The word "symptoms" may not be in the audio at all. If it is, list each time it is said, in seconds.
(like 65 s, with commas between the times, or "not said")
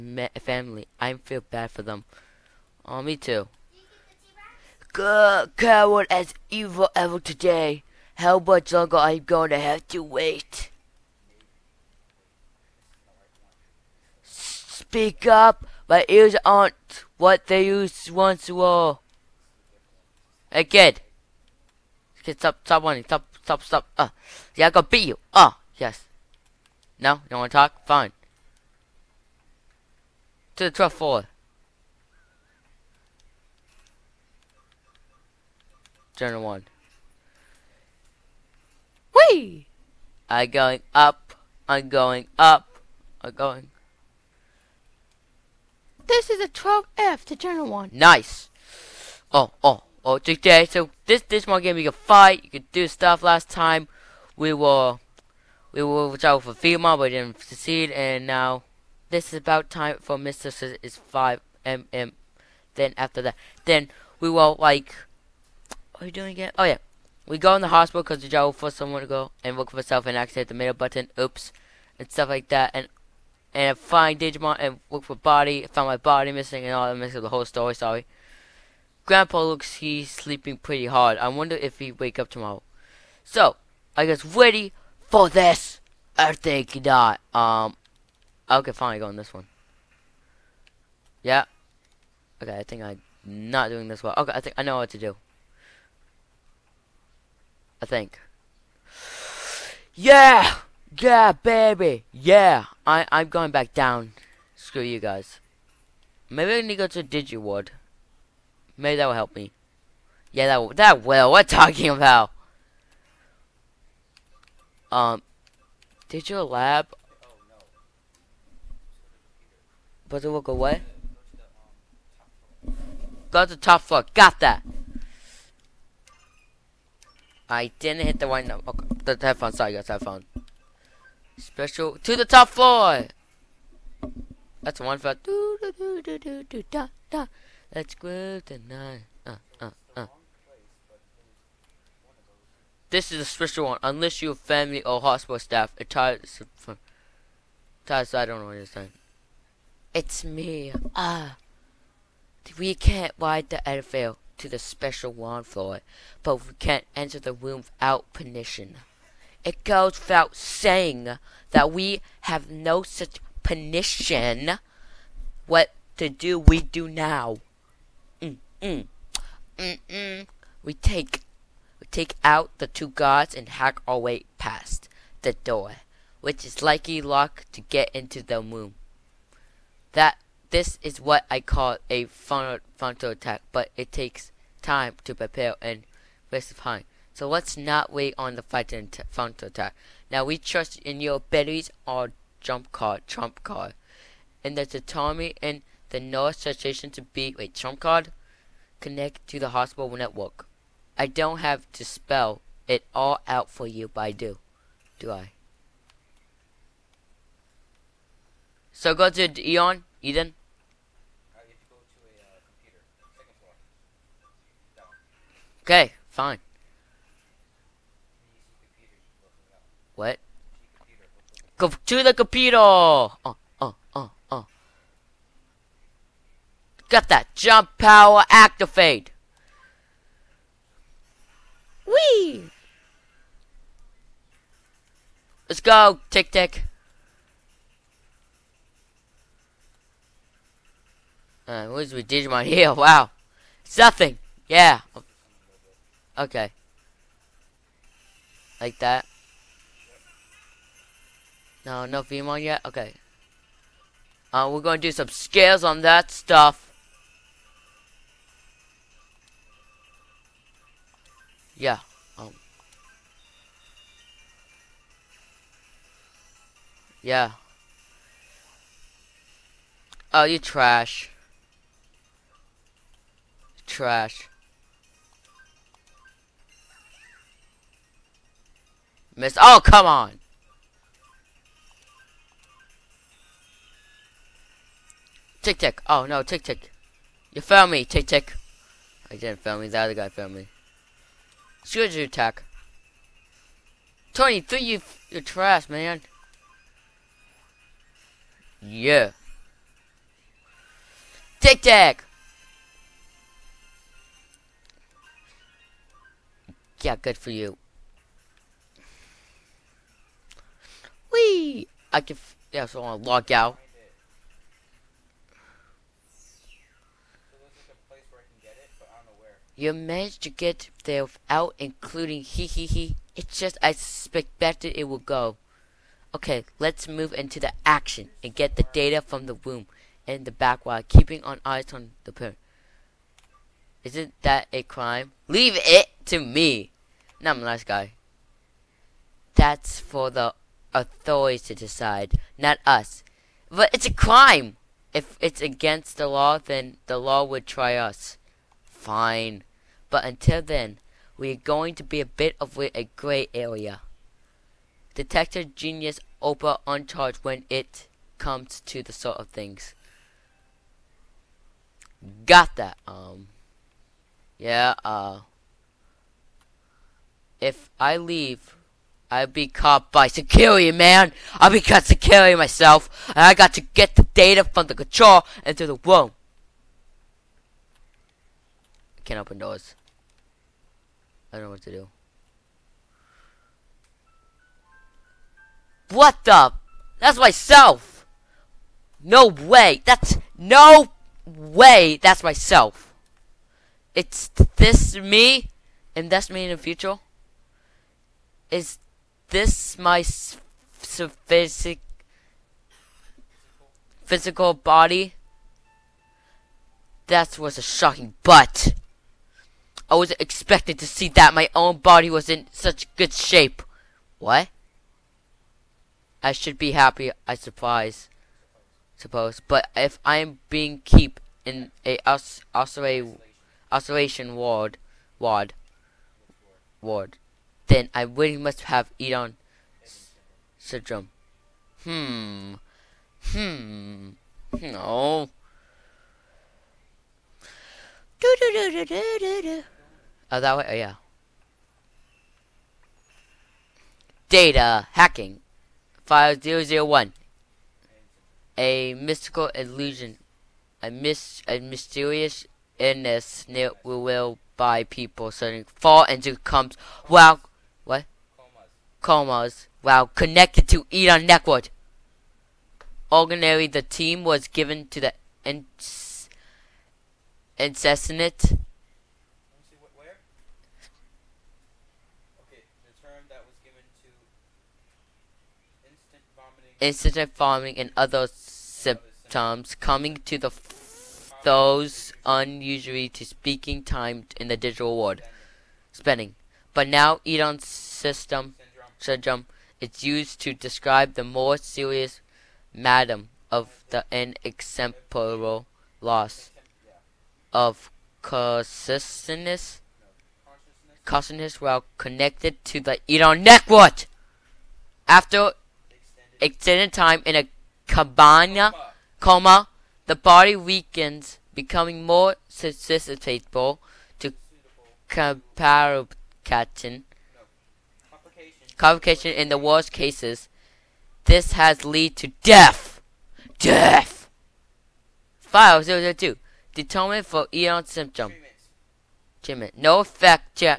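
478 s, 527 s.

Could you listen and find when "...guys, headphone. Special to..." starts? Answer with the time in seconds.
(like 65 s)
129 s.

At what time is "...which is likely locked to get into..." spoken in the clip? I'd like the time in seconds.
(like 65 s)
176 s.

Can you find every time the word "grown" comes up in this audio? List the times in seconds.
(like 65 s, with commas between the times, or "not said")
not said.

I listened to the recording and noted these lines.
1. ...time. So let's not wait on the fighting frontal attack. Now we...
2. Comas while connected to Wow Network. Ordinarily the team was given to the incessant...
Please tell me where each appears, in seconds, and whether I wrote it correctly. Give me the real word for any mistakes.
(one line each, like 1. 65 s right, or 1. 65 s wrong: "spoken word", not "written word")
1. 186 s right
2. 459 s wrong: "Elon", not "Wow".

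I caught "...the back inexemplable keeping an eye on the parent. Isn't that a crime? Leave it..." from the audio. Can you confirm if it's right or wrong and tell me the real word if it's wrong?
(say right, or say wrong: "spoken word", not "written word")
wrong: "while", not "inexemplable".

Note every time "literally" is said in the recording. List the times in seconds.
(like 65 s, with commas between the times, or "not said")
not said.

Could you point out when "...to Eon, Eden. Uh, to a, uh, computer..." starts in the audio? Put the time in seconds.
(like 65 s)
209 s.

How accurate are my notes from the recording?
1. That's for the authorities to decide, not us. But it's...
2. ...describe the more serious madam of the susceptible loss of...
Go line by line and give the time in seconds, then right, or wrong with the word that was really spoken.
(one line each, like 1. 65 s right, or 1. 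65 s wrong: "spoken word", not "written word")
1. 339 s right
2. 490 s wrong: "inexemplable", not "susceptible".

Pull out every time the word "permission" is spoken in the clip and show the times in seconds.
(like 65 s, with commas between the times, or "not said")
158 s, 163 s.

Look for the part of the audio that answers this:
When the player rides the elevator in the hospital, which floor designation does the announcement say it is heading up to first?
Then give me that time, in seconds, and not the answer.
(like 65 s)
36 s.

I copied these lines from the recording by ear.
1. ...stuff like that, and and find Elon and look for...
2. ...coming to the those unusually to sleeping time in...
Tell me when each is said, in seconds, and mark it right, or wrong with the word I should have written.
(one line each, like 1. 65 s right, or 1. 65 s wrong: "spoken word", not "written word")
1. 72 s wrong: "Digimon", not "Elon"
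2. 479 s wrong: "speaking", not "sleeping".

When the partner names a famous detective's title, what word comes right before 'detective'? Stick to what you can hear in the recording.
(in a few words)
genius.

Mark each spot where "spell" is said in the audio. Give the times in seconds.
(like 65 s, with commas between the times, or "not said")
201 s.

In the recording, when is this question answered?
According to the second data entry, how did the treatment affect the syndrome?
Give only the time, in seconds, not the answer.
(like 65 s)
529 s.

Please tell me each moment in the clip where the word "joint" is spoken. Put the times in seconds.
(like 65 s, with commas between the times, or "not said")
not said.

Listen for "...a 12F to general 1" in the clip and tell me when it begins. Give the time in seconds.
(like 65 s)
46 s.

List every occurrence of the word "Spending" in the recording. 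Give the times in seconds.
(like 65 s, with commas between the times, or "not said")
485 s.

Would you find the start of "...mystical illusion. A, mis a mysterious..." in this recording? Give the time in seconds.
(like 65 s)
448 s.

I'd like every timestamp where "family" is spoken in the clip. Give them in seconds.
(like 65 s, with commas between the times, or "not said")
0 s, 144 s.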